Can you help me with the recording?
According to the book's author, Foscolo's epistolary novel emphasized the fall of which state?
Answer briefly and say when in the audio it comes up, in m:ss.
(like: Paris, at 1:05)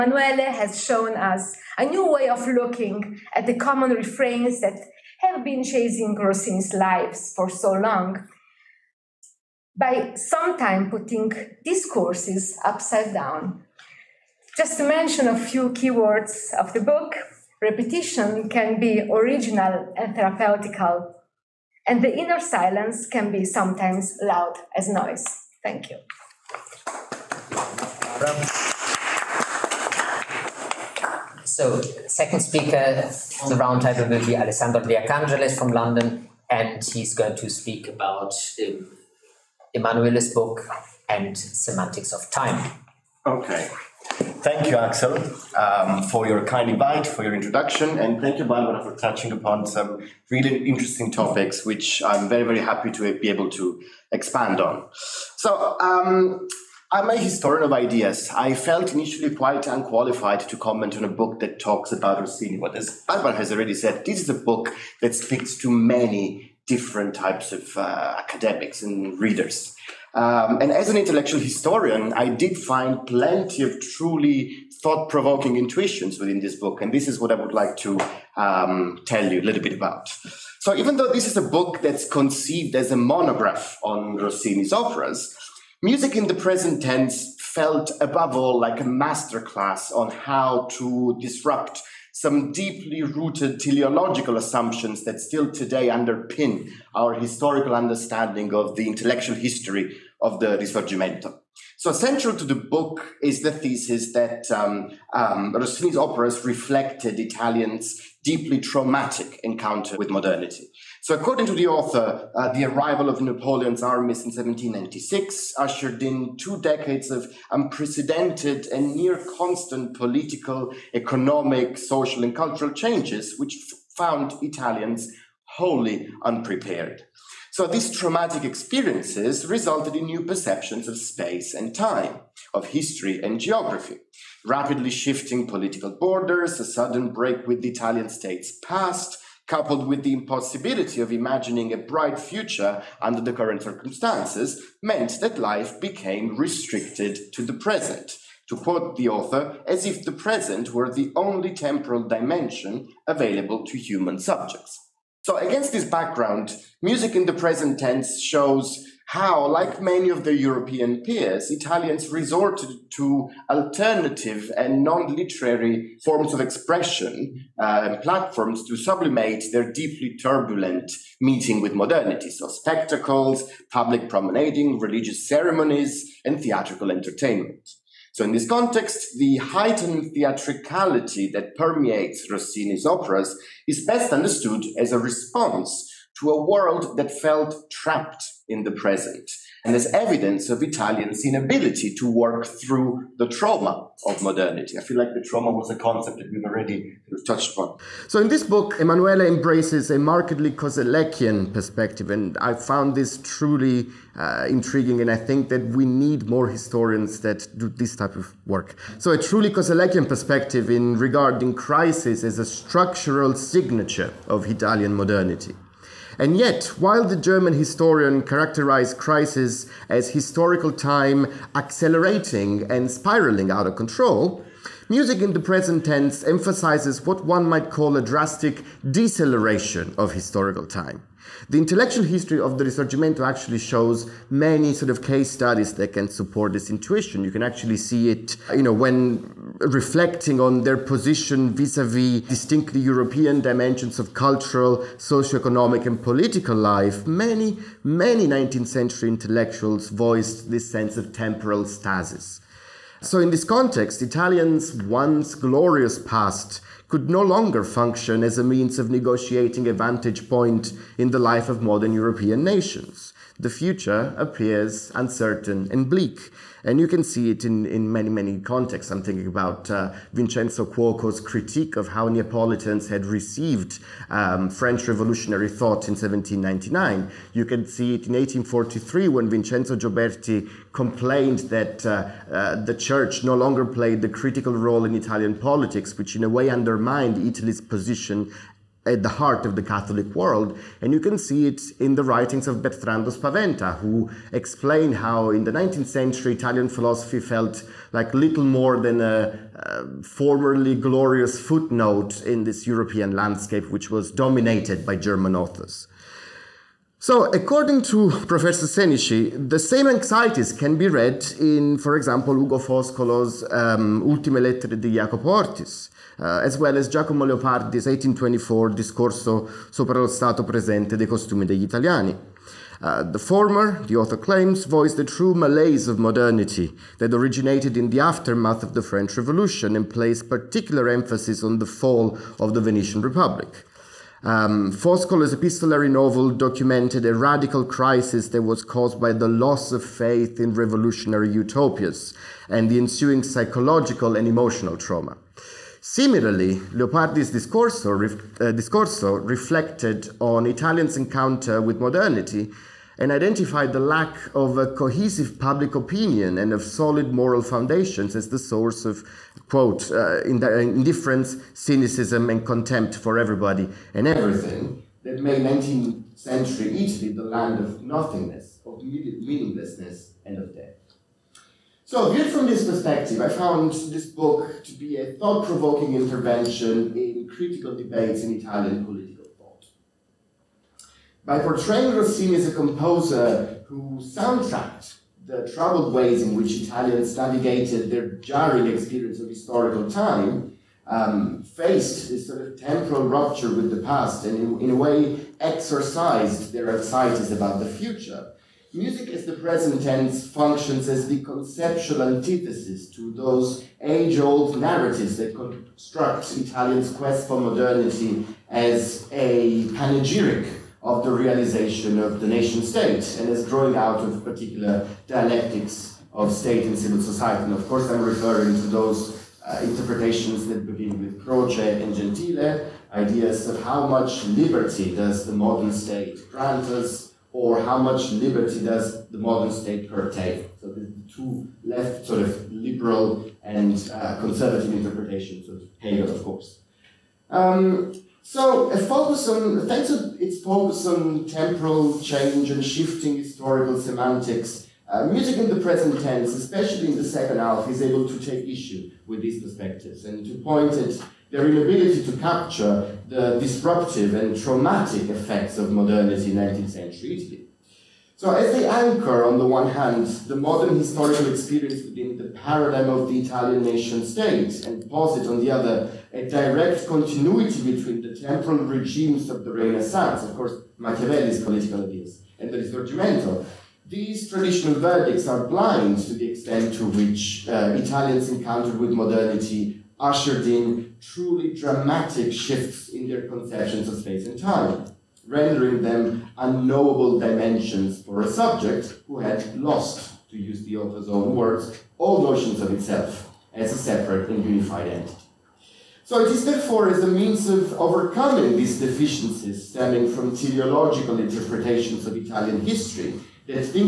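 Venetian Republic, at 5:32.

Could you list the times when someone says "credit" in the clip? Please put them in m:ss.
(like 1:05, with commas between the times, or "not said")
not said.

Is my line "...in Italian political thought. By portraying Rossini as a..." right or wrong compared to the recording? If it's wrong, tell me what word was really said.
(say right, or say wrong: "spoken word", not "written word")
right.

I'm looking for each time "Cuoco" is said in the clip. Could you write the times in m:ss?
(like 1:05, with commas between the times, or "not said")
4:30.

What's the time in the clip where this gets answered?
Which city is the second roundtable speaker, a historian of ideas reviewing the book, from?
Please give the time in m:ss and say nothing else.
0:35.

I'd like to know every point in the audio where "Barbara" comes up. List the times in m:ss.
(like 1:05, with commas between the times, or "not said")
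0:48, 1:03.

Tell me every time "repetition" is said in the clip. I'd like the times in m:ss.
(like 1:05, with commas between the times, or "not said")
0:17.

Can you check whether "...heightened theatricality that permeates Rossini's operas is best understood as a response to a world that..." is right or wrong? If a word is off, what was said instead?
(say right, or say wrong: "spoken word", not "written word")
right.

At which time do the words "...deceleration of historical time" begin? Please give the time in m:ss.
3:48.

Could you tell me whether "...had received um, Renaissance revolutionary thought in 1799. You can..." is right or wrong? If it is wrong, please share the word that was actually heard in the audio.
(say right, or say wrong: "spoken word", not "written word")
wrong: "French", not "Renaissance".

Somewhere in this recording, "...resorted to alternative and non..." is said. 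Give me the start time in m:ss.
2:42.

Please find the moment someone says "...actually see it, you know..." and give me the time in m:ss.
3:57.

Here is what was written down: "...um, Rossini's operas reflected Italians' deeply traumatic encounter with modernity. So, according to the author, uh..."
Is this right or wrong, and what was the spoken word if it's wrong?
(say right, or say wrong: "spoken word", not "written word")
right.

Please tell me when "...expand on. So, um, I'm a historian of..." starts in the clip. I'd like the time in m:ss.
0:54.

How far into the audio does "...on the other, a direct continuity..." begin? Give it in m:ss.
7:45.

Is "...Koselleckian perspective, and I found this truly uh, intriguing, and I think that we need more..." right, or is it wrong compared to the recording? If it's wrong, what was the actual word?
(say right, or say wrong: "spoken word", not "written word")
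right.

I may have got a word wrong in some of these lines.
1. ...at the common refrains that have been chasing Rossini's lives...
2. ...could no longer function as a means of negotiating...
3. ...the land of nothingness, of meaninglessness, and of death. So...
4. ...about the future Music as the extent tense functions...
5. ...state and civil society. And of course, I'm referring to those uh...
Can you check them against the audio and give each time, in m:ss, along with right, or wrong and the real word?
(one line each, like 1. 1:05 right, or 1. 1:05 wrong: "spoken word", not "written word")
1. 0:03 right
2. 4:16 right
3. 6:07 right
4. 6:37 wrong: "present", not "extent"
5. 6:56 right.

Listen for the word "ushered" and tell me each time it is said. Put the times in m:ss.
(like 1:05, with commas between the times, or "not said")
1:55, 7:59.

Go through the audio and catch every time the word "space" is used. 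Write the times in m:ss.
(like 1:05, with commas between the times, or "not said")
2:10, 8:03.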